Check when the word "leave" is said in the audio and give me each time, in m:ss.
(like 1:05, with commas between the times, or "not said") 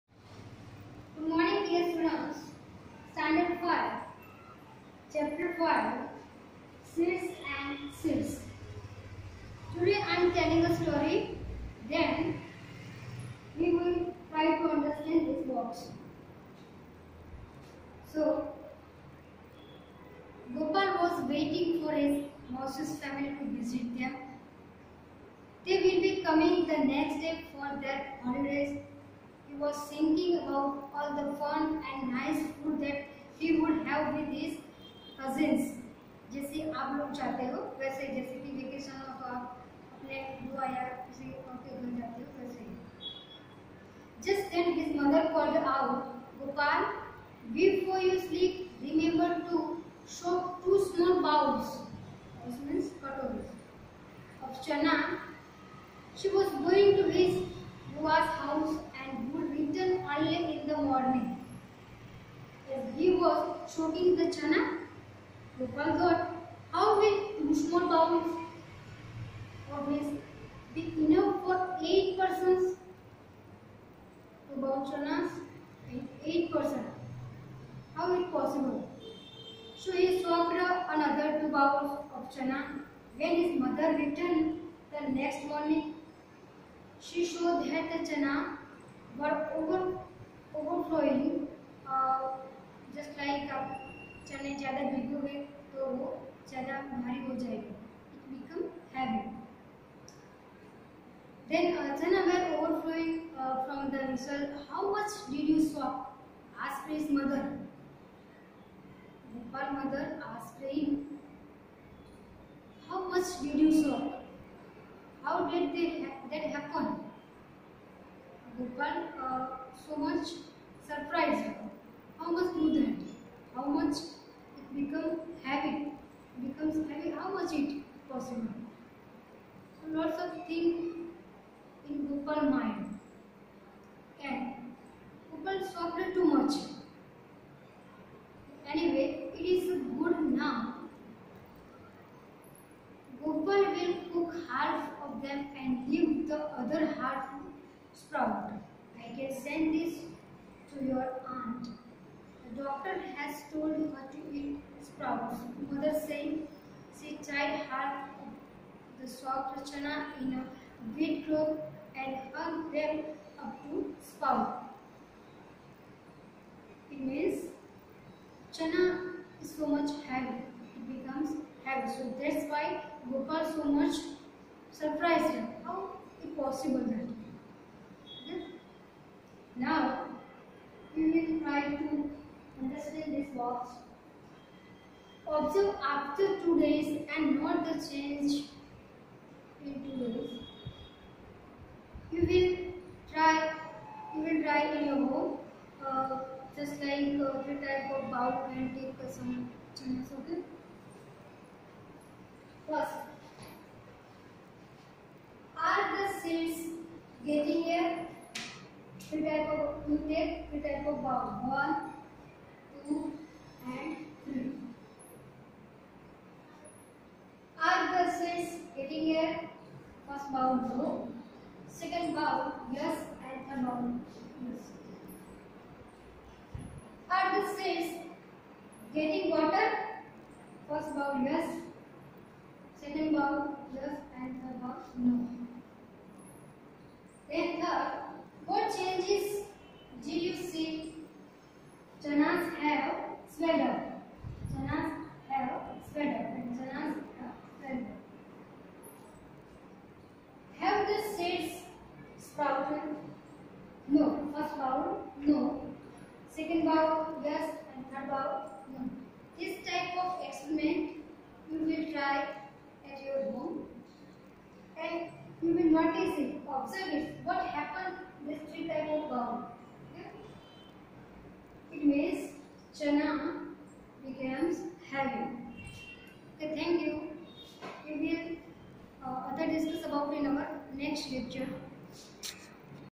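2:25.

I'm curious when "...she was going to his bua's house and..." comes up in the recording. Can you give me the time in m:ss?
0:56.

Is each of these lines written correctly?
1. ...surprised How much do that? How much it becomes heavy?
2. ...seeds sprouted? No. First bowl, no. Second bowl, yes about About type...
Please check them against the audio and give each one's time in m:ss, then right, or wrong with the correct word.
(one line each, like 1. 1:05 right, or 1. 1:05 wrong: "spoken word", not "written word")
1. 2:00 right
2. 4:11 wrong: "This", not "About".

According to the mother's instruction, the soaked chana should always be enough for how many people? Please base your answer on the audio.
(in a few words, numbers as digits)
8.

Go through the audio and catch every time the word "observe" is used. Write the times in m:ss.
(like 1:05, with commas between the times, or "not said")
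3:05, 4:26.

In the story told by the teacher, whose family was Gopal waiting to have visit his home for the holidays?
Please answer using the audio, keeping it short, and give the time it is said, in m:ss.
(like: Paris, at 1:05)
His Mausi's family, at 0:22.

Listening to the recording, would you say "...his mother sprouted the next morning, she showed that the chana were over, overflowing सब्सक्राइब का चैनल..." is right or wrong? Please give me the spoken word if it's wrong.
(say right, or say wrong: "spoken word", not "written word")
wrong: "returned", not "sprouted".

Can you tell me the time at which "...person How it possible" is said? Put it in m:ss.
1:16.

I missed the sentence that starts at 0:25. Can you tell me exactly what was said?
They will be coming the next day for their holidays.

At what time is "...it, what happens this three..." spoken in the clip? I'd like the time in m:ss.
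4:26.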